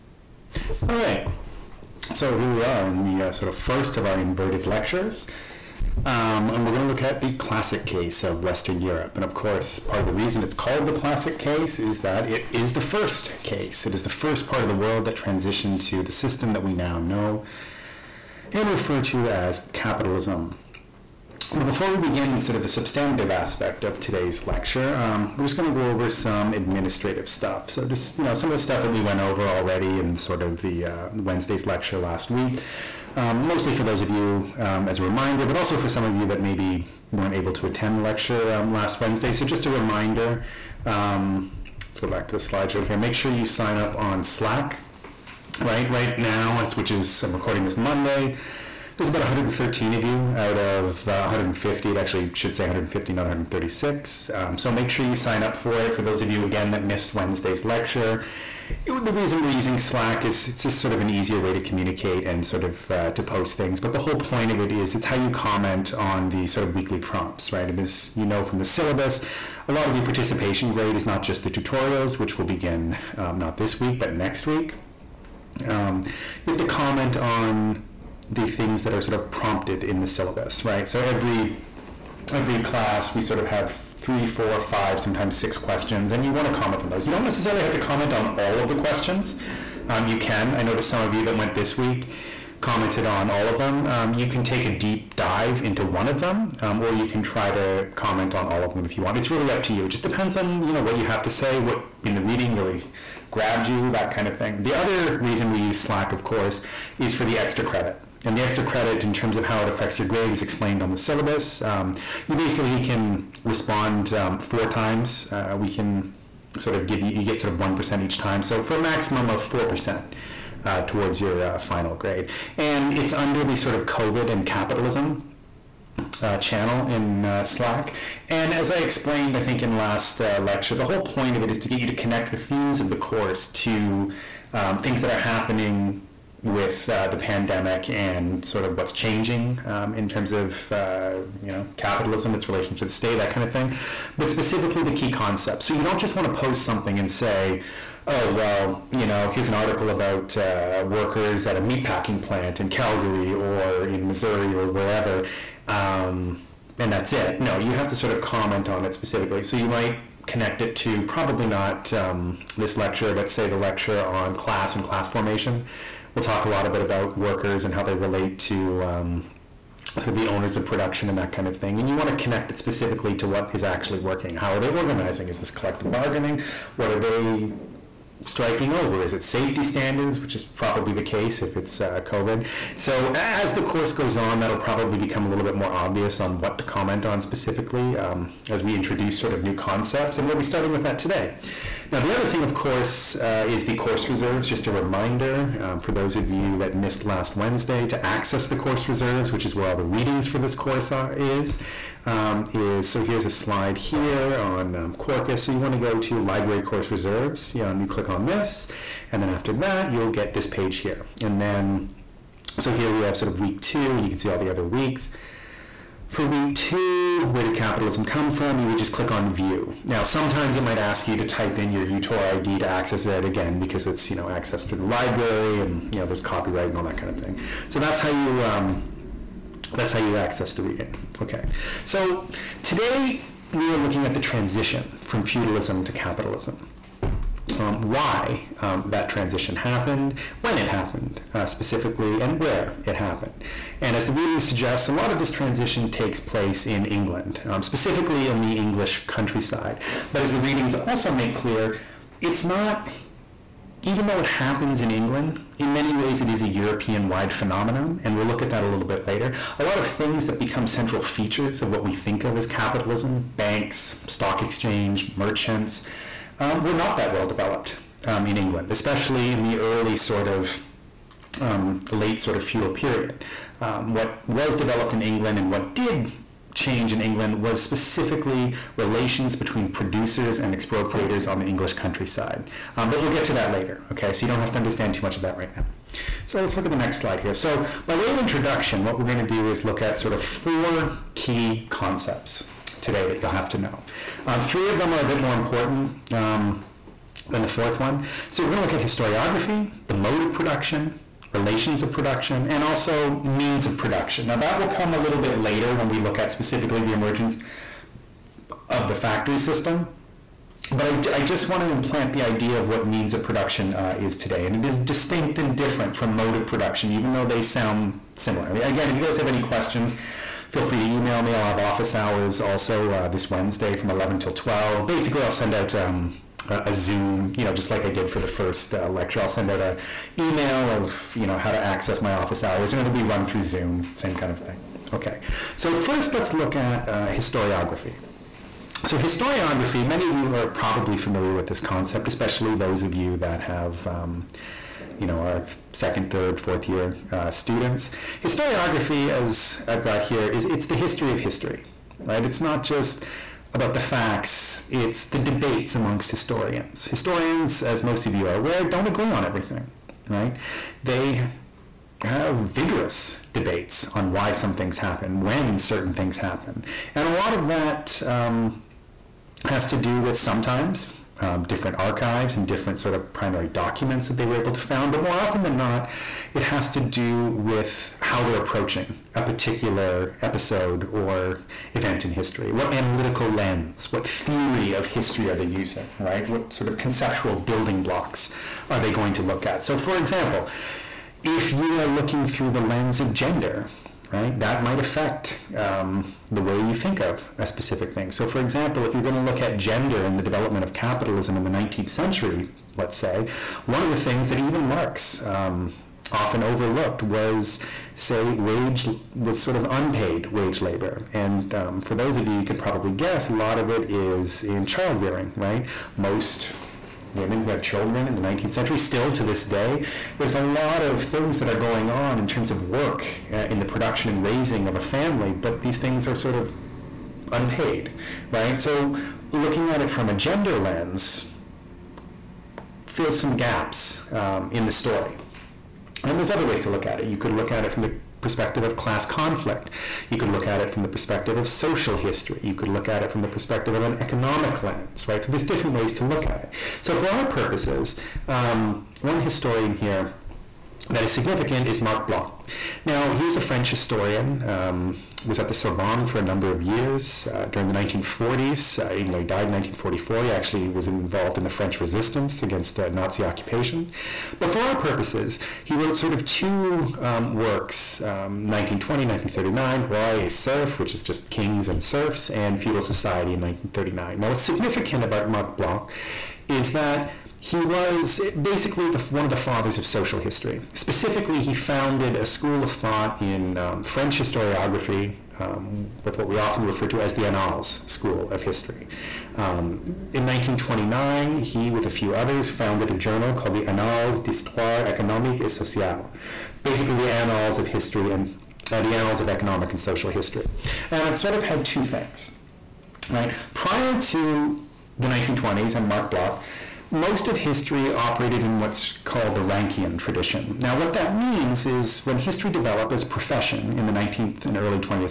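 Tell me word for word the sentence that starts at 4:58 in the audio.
So we're going to look at historiography, the mode of production, relations of production, and also means of production.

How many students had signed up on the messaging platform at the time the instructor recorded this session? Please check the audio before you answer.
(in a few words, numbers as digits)
113.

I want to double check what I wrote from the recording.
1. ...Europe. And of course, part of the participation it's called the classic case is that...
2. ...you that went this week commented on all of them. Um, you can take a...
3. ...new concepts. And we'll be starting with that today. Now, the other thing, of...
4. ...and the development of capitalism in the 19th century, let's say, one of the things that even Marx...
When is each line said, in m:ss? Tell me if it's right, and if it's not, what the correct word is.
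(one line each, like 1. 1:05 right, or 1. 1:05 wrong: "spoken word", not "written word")
1. 0:08 wrong: "reason", not "participation"
2. 1:31 right
3. 3:09 right
4. 6:40 right.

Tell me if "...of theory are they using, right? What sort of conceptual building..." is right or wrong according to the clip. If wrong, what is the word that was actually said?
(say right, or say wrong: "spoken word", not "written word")
wrong: "history", not "theory".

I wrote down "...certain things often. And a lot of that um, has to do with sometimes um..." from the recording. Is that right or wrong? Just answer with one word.
wrong.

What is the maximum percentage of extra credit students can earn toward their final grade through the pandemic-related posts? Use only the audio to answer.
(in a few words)
4%.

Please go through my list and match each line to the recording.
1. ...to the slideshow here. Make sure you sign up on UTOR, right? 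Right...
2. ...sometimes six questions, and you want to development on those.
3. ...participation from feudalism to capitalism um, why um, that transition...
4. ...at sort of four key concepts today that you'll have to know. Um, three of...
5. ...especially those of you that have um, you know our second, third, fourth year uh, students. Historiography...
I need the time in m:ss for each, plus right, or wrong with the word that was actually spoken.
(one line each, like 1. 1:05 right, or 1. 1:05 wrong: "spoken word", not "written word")
1. 0:42 wrong: "Slack", not "UTOR"
2. 1:24 wrong: "comment", not "development"
3. 3:54 wrong: "transition", not "participation"
4. 4:49 right
5. 5:42 right.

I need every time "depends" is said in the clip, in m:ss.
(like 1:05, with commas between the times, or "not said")
1:40.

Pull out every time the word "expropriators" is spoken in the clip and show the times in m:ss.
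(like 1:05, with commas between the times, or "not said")
4:40.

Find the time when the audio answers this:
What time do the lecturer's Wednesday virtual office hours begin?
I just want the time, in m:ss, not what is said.
5:23.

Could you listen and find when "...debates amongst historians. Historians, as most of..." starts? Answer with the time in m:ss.
5:55.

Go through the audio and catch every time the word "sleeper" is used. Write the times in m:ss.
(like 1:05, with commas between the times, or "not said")
not said.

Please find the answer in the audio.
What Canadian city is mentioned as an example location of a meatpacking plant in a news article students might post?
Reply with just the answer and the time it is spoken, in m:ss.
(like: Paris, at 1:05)
Calgary, at 2:32.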